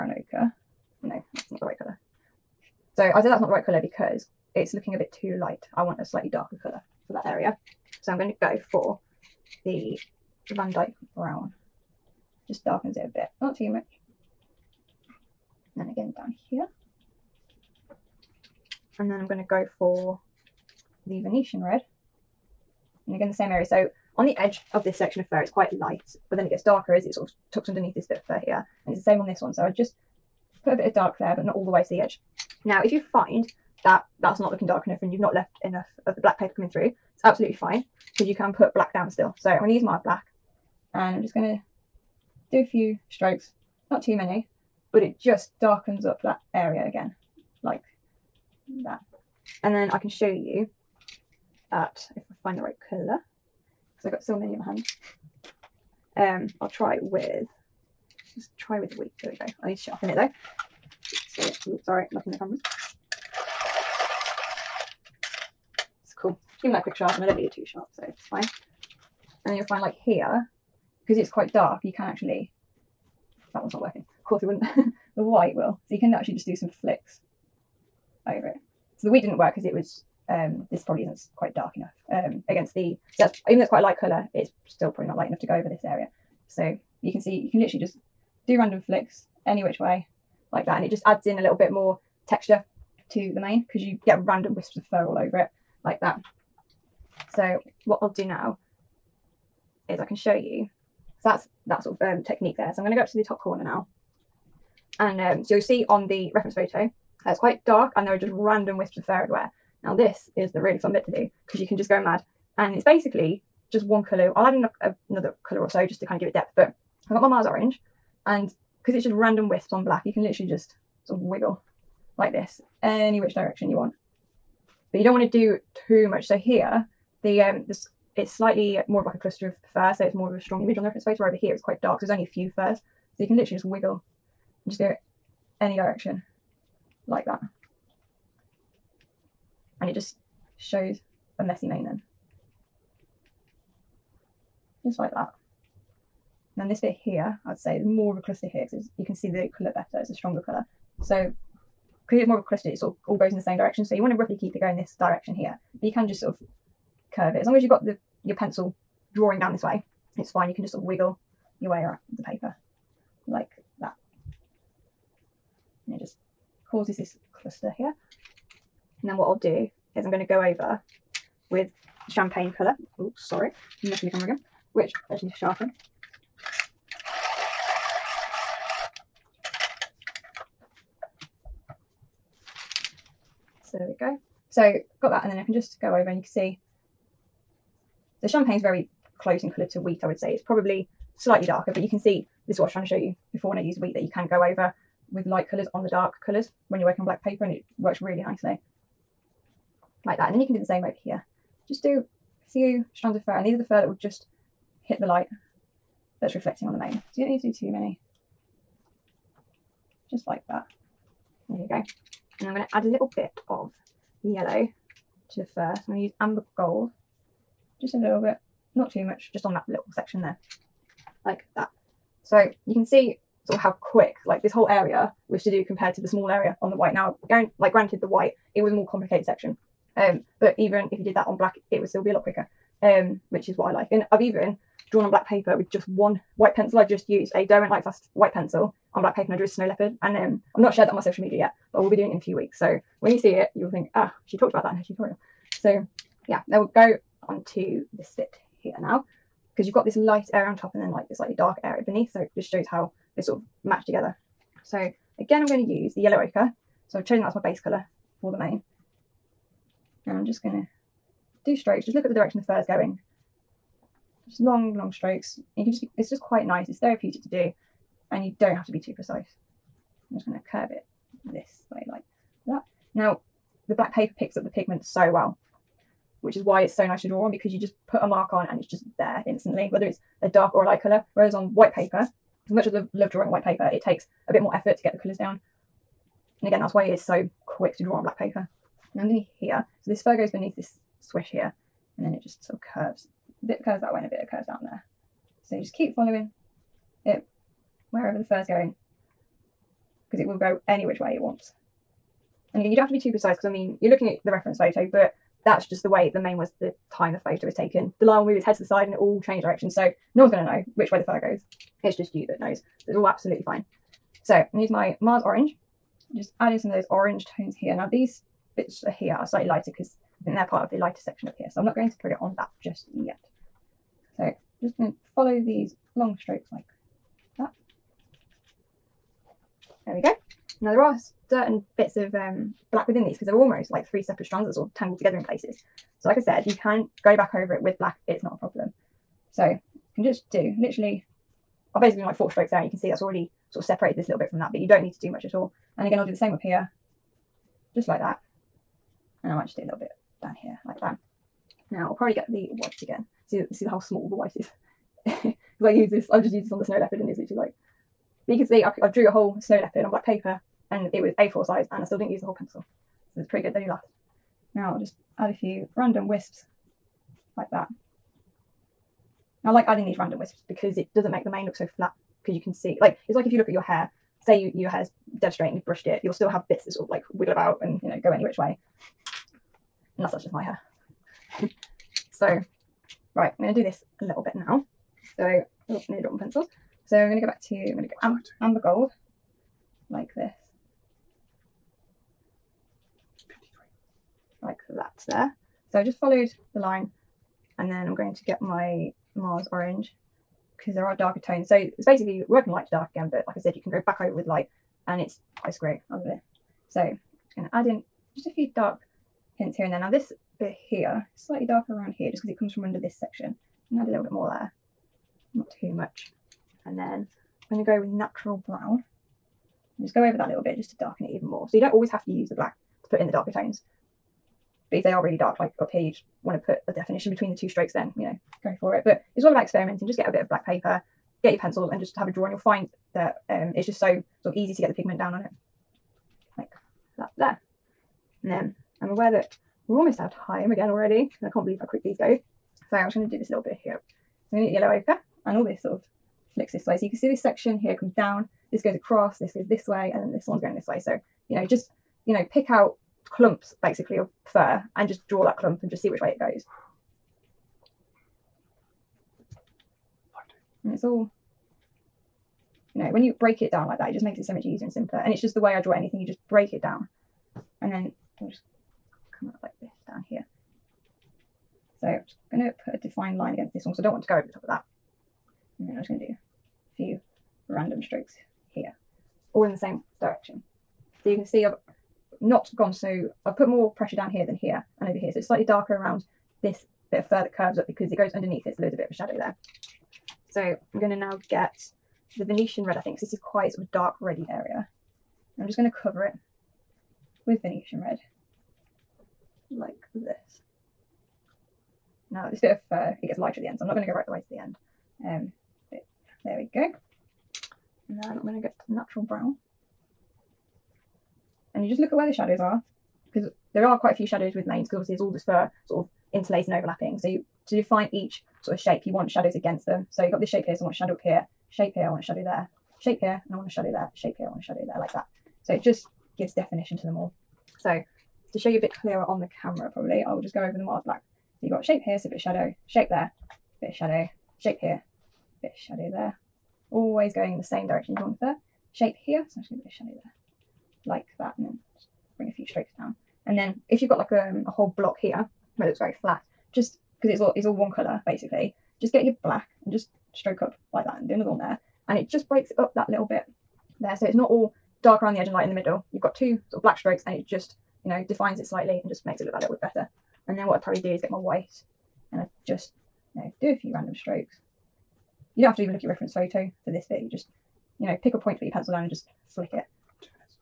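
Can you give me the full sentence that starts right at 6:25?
So, oh, nearly dropped my pencils.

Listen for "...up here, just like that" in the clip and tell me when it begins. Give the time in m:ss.
5:46.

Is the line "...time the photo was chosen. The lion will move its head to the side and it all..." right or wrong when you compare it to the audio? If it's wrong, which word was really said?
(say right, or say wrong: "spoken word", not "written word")
wrong: "taken", not "chosen".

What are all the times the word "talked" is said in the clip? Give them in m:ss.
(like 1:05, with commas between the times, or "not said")
4:04.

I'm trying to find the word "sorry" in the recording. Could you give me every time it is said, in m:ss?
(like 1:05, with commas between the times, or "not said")
1:01, 2:53.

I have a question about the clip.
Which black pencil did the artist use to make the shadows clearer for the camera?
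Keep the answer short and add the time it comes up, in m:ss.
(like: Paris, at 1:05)
Mars black, at 8:50.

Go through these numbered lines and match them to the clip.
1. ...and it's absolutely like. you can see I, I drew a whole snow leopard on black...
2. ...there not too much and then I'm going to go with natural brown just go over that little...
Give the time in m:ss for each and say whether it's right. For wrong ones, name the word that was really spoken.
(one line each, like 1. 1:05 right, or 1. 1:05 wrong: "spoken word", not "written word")
1. 5:56 wrong: "literally", not "absolutely"
2. 6:54 right.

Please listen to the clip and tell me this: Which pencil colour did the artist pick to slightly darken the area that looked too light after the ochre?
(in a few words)
Van Dyke brown.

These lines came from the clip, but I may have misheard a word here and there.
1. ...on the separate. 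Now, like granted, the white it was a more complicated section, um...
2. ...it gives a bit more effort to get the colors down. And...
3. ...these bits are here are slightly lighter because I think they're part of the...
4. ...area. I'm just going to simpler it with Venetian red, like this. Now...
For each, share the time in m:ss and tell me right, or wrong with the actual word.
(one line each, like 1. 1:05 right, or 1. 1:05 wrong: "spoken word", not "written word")
1. 3:46 wrong: "white", not "separate"
2. 4:43 wrong: "takes", not "gives"
3. 5:17 right
4. 8:14 wrong: "cover", not "simpler".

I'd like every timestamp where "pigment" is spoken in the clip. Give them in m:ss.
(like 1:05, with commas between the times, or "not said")
4:34, 7:14.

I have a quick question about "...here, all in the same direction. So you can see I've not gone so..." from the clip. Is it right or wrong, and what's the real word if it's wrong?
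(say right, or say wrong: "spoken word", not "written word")
right.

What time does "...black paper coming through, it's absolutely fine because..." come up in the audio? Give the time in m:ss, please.
0:36.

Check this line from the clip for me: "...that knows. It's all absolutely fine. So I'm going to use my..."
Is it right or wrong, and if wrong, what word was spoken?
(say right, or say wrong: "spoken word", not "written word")
right.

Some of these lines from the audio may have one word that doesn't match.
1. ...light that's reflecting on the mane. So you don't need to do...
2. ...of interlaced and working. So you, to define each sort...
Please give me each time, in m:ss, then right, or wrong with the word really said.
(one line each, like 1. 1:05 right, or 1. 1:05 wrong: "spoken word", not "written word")
1. 3:25 right
2. 8:35 wrong: "overlapping", not "working".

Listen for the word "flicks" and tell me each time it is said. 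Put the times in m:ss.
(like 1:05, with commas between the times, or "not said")
1:16, 1:28, 7:26, 9:29.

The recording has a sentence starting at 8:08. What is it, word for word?
So there's a bit of a shadow there.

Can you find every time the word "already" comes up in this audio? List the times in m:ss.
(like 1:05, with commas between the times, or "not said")
5:43, 7:20.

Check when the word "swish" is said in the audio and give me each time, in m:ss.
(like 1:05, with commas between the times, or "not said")
4:51.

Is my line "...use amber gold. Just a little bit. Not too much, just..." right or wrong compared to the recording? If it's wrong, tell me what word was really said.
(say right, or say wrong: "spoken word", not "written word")
right.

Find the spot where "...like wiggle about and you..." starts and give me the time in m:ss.
6:16.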